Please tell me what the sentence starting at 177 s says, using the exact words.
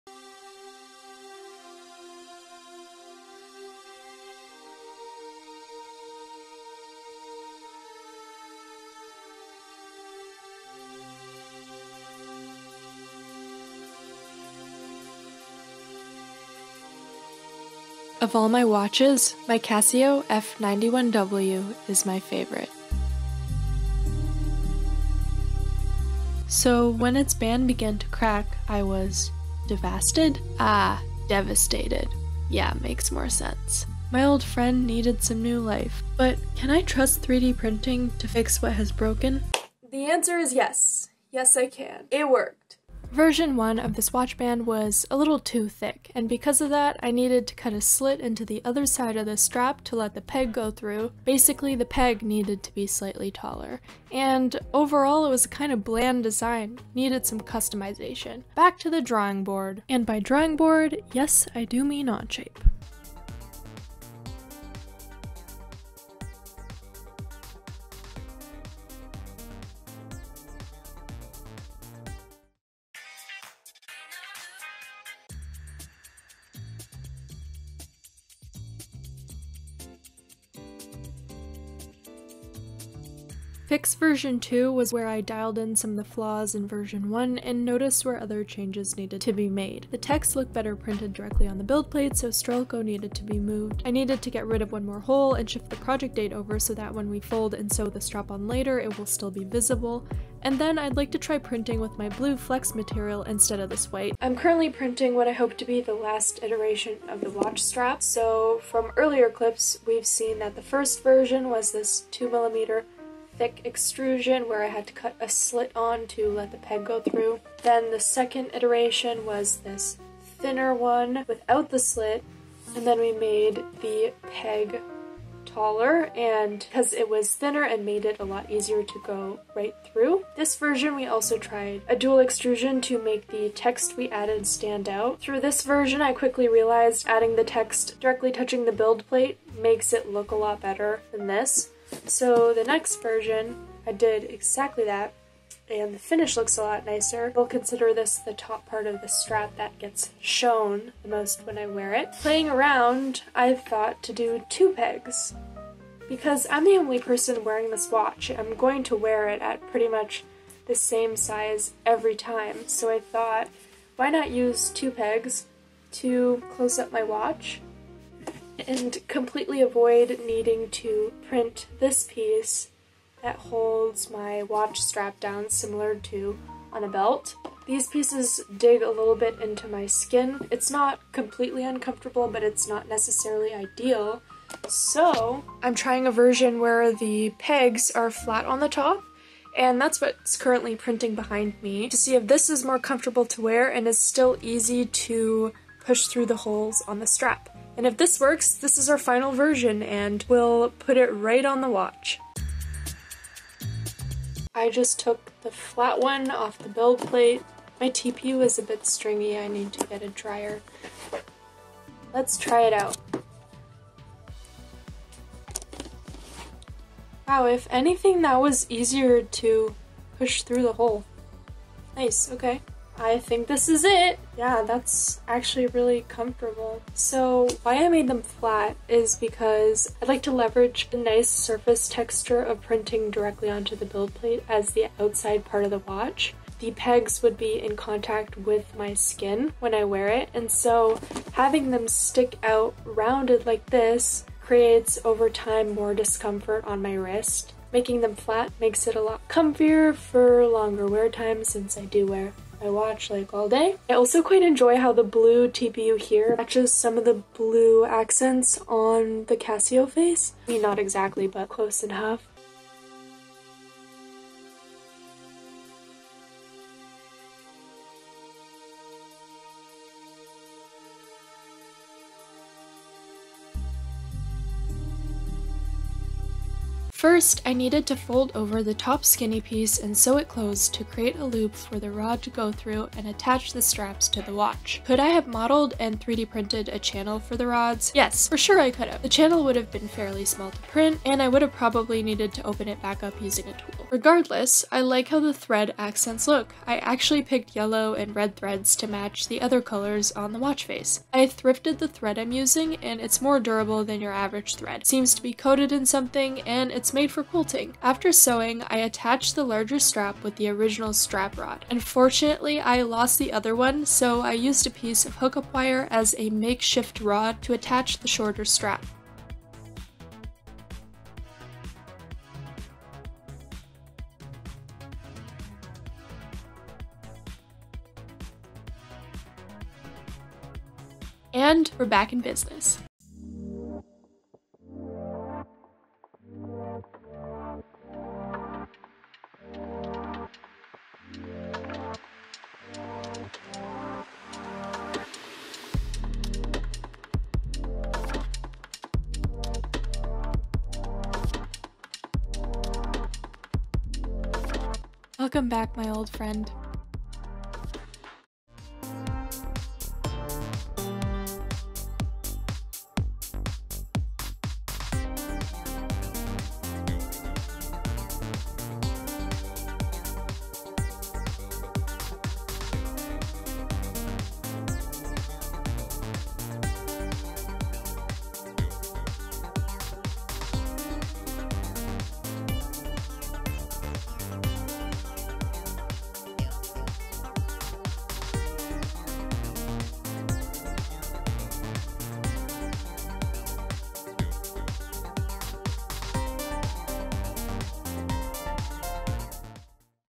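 These pieces dig a little bit into my skin.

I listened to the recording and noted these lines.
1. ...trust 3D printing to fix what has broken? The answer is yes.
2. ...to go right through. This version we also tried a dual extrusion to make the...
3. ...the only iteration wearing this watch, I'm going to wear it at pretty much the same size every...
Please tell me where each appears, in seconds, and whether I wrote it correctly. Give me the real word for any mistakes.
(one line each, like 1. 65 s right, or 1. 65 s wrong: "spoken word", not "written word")
1. 36 s right
2. 128 s right
3. 156 s wrong: "person", not "iteration".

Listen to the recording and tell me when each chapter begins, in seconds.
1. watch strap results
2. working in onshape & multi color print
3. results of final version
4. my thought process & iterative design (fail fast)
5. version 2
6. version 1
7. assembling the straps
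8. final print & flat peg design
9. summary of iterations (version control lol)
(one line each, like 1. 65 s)
1. 332 s
2. 62 s
3. 204 s
4. 104 s
5. 83 s
6. 42 s
7. 275 s
8. 185 s
9. 262 s.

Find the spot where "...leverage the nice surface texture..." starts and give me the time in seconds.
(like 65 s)
230 s.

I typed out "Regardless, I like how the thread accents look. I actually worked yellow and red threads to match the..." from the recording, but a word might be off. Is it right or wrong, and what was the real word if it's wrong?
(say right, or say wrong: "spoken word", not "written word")
wrong: "picked", not "worked".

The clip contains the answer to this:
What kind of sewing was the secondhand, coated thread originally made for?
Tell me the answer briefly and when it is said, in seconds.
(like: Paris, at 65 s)
quilting, at 307 s.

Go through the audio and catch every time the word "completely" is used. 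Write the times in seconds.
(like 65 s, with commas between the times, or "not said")
169 s, 181 s.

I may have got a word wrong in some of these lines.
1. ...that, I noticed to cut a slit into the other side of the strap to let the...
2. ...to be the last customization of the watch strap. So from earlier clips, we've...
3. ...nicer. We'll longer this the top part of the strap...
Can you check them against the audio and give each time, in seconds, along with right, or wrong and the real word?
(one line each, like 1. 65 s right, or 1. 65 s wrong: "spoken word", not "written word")
1. 46 s wrong: "needed", not "noticed"
2. 105 s wrong: "iteration", not "customization"
3. 146 s wrong: "consider", not "longer".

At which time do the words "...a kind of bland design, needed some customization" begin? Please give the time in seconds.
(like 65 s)
55 s.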